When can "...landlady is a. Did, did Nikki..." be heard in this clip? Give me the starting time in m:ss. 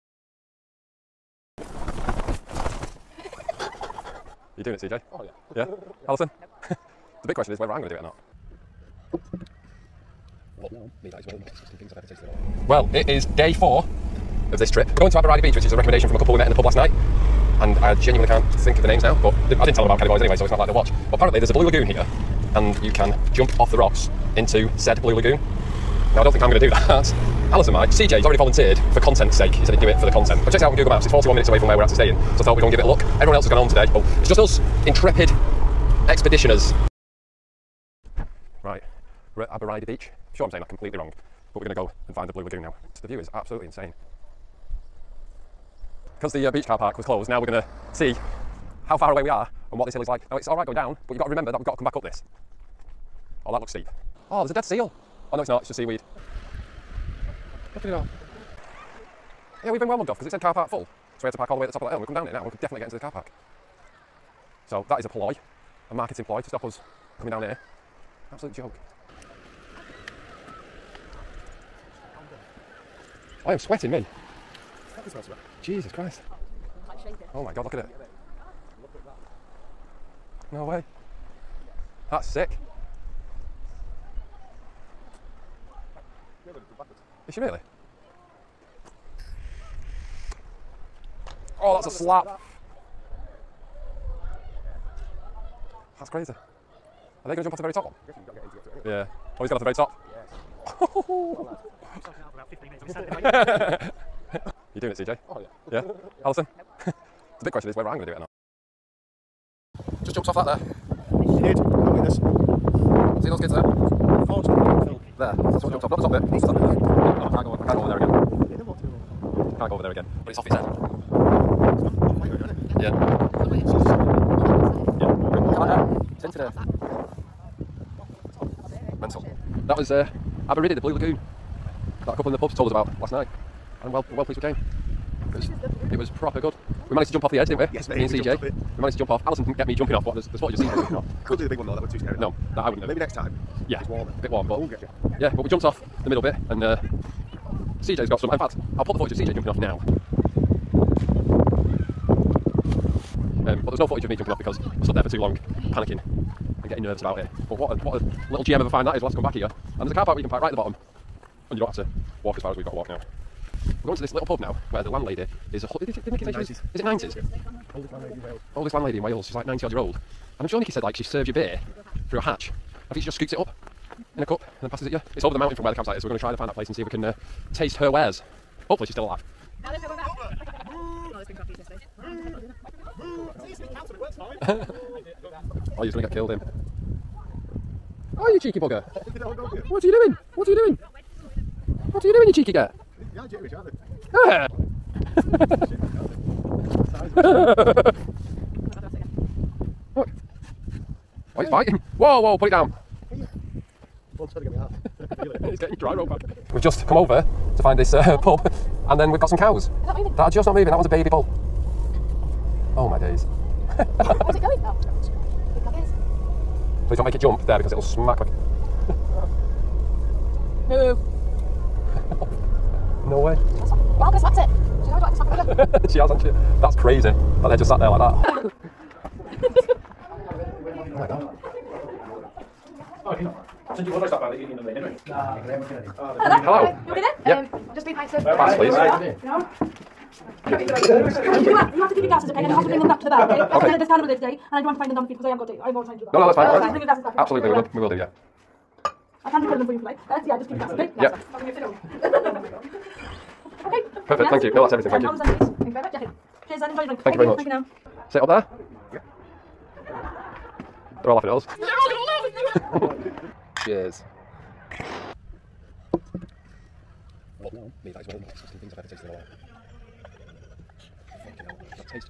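2:44.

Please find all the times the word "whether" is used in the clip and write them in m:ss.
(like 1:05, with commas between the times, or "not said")
0:07, 1:47.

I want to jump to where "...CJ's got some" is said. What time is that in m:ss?
2:27.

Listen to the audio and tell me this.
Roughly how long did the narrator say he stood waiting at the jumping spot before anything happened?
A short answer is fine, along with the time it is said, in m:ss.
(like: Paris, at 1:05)
15 minutes, at 1:42.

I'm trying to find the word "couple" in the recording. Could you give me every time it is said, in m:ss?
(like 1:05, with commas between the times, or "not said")
0:16, 2:12.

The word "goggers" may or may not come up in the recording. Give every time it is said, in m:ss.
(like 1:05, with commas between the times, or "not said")
3:35.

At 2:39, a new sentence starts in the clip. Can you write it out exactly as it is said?
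And there's a car park where you can park right at the bottom.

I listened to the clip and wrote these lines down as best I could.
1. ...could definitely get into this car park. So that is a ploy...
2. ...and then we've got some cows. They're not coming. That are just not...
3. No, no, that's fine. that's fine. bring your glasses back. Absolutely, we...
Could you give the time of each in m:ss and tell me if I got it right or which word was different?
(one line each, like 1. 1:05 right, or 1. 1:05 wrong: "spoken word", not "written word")
1. 1:02 right
2. 3:28 wrong: "moving", not "coming"
3. 4:06 right.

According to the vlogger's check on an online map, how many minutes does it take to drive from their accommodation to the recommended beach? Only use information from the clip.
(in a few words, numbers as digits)
41 minutes.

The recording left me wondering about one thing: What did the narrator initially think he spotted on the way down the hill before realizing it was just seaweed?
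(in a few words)
A dead seal.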